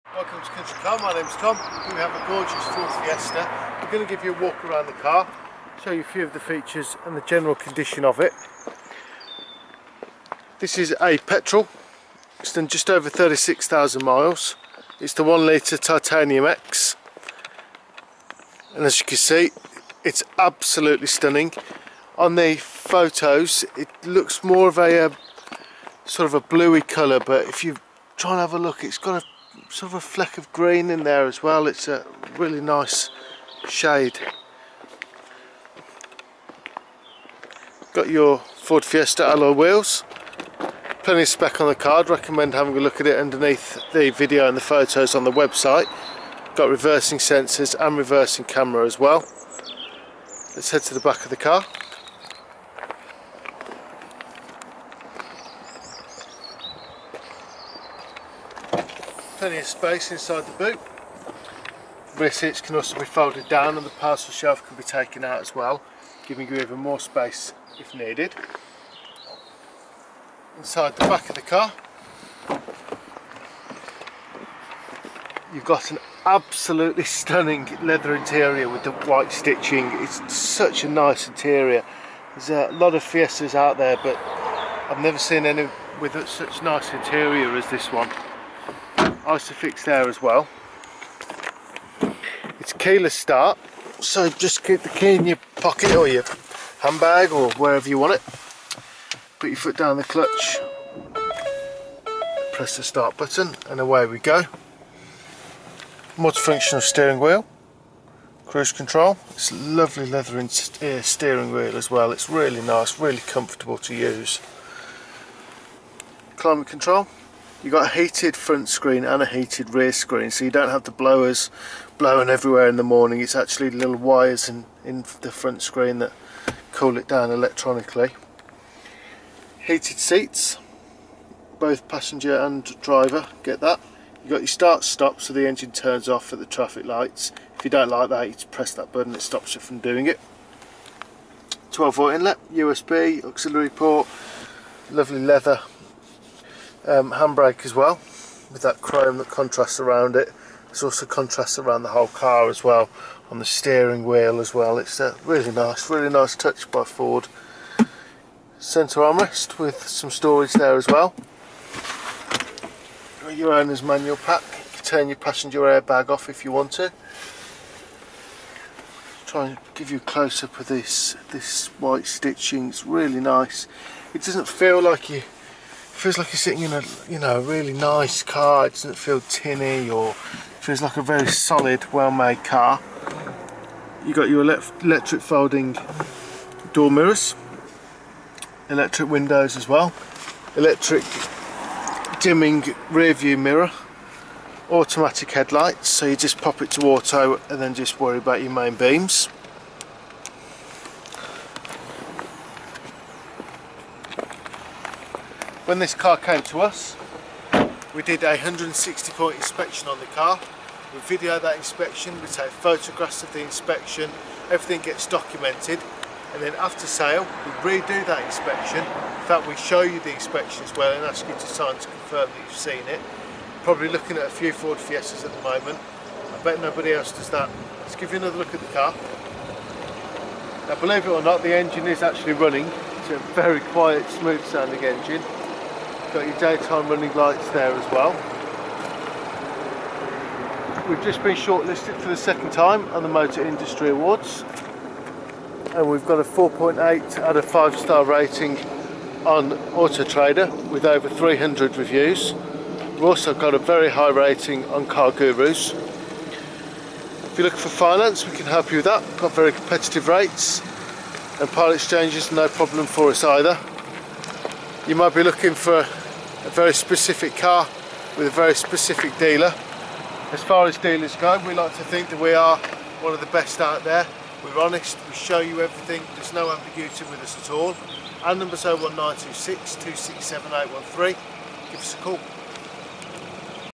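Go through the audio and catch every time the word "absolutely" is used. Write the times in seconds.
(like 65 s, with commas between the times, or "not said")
20 s, 76 s.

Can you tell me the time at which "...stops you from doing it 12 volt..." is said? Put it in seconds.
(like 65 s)
139 s.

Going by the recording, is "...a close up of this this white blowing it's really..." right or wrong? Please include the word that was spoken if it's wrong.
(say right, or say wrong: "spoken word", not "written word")
wrong: "stitching", not "blowing".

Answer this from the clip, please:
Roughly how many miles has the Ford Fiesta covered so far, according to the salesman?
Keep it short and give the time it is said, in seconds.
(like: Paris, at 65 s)
36,000, at 13 s.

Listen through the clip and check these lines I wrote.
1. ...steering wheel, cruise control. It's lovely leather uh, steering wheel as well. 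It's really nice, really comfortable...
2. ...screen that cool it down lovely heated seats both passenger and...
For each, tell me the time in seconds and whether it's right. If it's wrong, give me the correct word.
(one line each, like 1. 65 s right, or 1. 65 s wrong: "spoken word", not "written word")
1. 106 s right
2. 125 s wrong: "electronically", not "lovely".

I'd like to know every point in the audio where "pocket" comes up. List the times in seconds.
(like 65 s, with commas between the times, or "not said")
95 s.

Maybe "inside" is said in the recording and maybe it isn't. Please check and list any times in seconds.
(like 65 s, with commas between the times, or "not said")
60 s, 70 s.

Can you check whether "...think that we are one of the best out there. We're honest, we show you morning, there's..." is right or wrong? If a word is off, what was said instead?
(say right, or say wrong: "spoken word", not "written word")
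wrong: "everything", not "morning".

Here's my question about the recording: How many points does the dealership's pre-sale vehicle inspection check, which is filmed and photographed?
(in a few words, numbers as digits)
160.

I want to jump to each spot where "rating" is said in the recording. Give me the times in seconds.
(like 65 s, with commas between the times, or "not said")
248 s, 254 s.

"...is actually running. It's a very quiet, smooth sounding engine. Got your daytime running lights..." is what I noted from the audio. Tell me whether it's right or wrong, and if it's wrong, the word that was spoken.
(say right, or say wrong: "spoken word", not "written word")
right.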